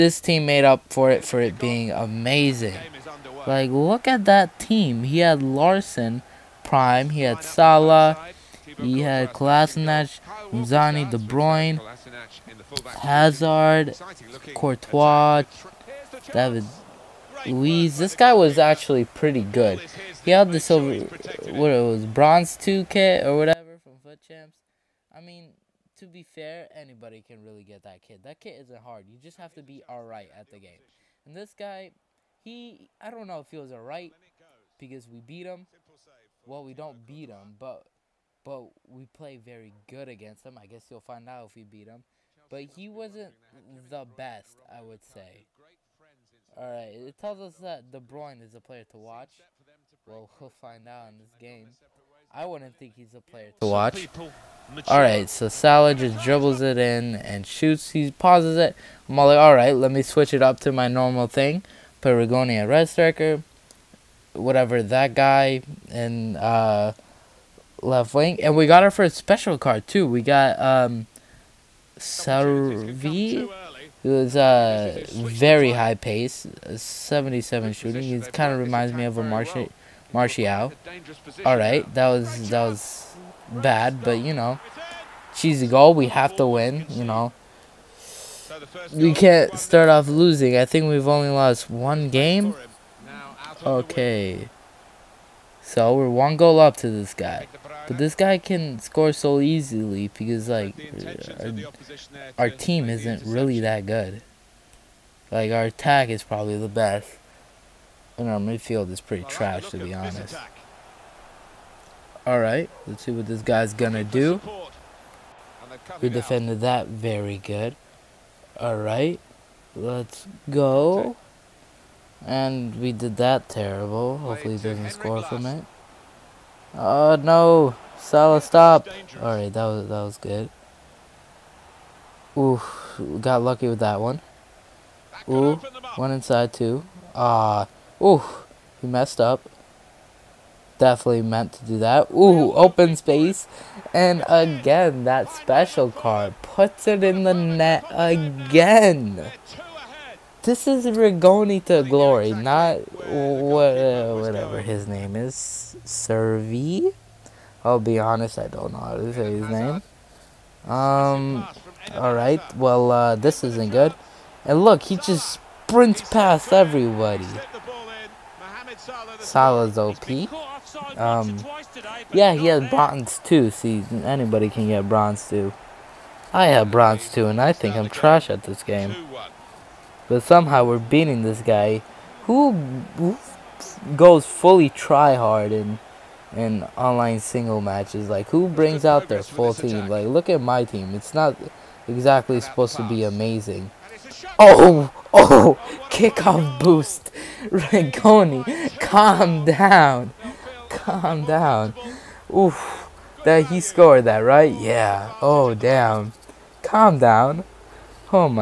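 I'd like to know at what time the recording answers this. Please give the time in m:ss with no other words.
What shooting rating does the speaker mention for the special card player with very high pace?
1:16.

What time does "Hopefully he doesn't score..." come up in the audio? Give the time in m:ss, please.
2:04.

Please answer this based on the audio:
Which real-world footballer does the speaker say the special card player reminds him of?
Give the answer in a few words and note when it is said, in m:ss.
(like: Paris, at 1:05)
Martial, at 1:20.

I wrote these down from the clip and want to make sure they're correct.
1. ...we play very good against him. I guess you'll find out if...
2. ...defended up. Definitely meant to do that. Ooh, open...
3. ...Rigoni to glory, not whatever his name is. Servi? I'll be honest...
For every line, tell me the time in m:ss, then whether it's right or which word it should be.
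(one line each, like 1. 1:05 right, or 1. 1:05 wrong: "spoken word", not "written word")
1. 0:38 right
2. 2:18 wrong: "messed", not "defended"
3. 2:30 right.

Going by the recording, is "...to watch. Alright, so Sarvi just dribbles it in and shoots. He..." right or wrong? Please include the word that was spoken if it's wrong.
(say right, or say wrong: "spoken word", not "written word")
wrong: "Salah", not "Sarvi".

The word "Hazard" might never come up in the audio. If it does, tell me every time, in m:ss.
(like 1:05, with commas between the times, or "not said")
0:12.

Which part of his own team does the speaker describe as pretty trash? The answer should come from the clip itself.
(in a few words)
Midfield.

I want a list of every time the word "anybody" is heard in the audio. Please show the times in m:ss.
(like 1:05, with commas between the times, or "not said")
0:26, 2:54.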